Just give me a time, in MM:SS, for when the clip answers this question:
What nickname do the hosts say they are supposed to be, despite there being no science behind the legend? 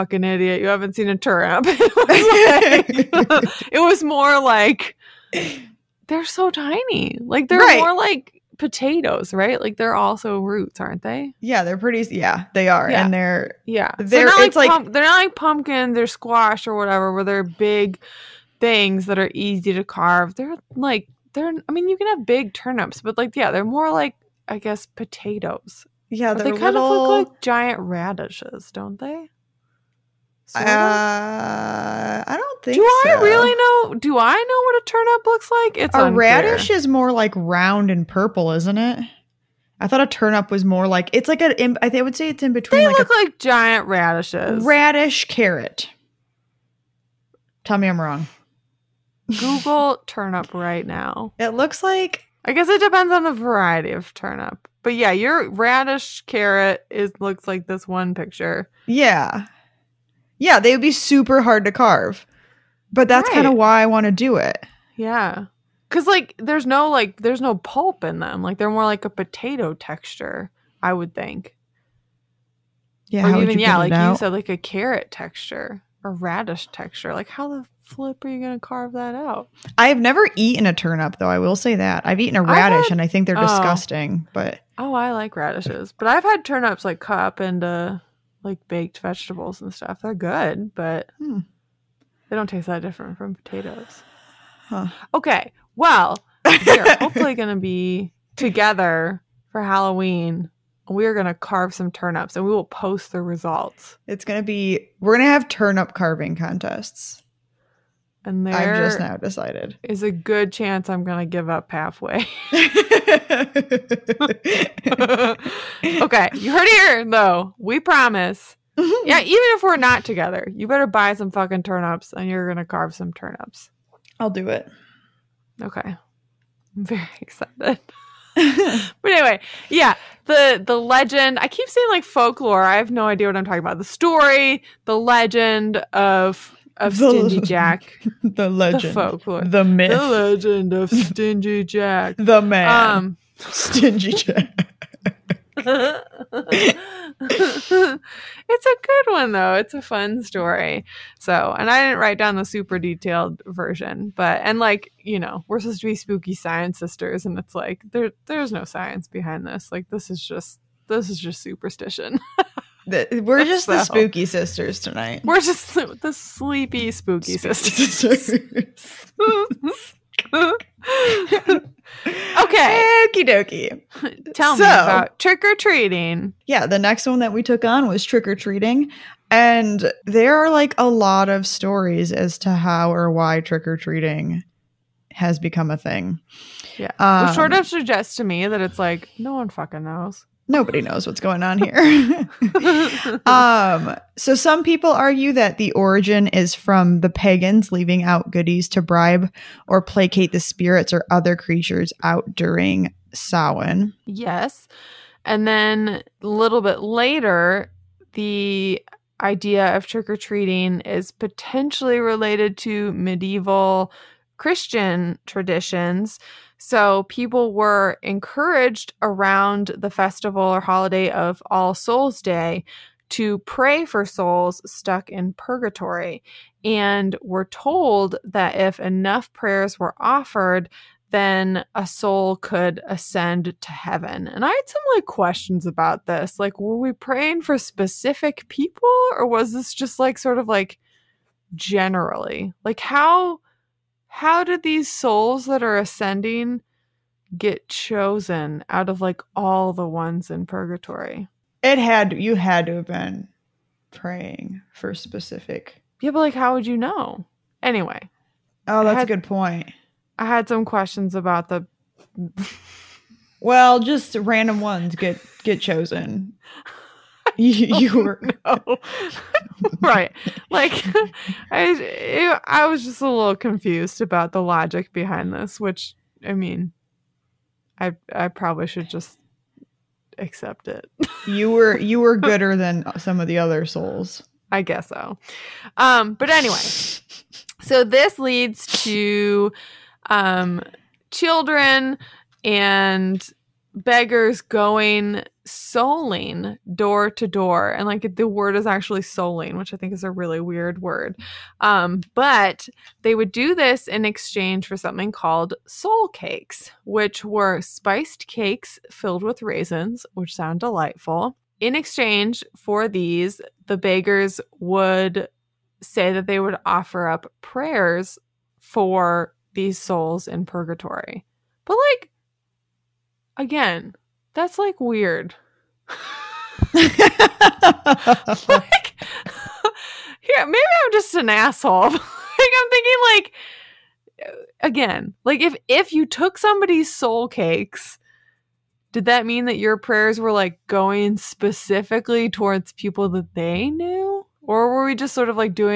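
02:35.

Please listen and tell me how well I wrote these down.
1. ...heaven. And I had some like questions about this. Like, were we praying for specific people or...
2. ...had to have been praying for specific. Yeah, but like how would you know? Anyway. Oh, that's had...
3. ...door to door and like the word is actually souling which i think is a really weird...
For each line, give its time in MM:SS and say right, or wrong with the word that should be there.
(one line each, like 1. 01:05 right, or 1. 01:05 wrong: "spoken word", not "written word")
1. 03:53 right
2. 04:12 right
3. 04:56 right.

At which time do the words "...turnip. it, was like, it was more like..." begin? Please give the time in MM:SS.
00:01.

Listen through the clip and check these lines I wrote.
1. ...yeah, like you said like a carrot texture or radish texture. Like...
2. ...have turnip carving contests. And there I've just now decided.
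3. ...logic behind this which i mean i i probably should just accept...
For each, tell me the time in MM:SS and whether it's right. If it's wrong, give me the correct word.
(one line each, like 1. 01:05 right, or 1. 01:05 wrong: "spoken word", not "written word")
1. 01:13 right
2. 01:45 right
3. 04:34 right.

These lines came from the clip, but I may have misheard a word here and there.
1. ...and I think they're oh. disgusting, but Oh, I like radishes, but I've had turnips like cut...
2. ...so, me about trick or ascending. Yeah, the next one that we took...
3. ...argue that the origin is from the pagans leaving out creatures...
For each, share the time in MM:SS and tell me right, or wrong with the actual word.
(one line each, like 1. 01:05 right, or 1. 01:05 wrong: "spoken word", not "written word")
1. 01:22 right
2. 02:54 wrong: "treating", not "ascending"
3. 03:14 wrong: "goodies", not "creatures".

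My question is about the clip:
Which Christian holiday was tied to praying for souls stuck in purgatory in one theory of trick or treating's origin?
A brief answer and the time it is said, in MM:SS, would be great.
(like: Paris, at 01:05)
All Souls Day, at 03:41.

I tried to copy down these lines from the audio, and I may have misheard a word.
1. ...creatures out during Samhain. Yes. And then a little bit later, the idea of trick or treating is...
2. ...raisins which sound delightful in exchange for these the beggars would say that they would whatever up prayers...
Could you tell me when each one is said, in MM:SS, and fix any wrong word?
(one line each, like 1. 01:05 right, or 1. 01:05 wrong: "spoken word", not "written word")
1. 03:21 right
2. 05:09 wrong: "offer", not "whatever".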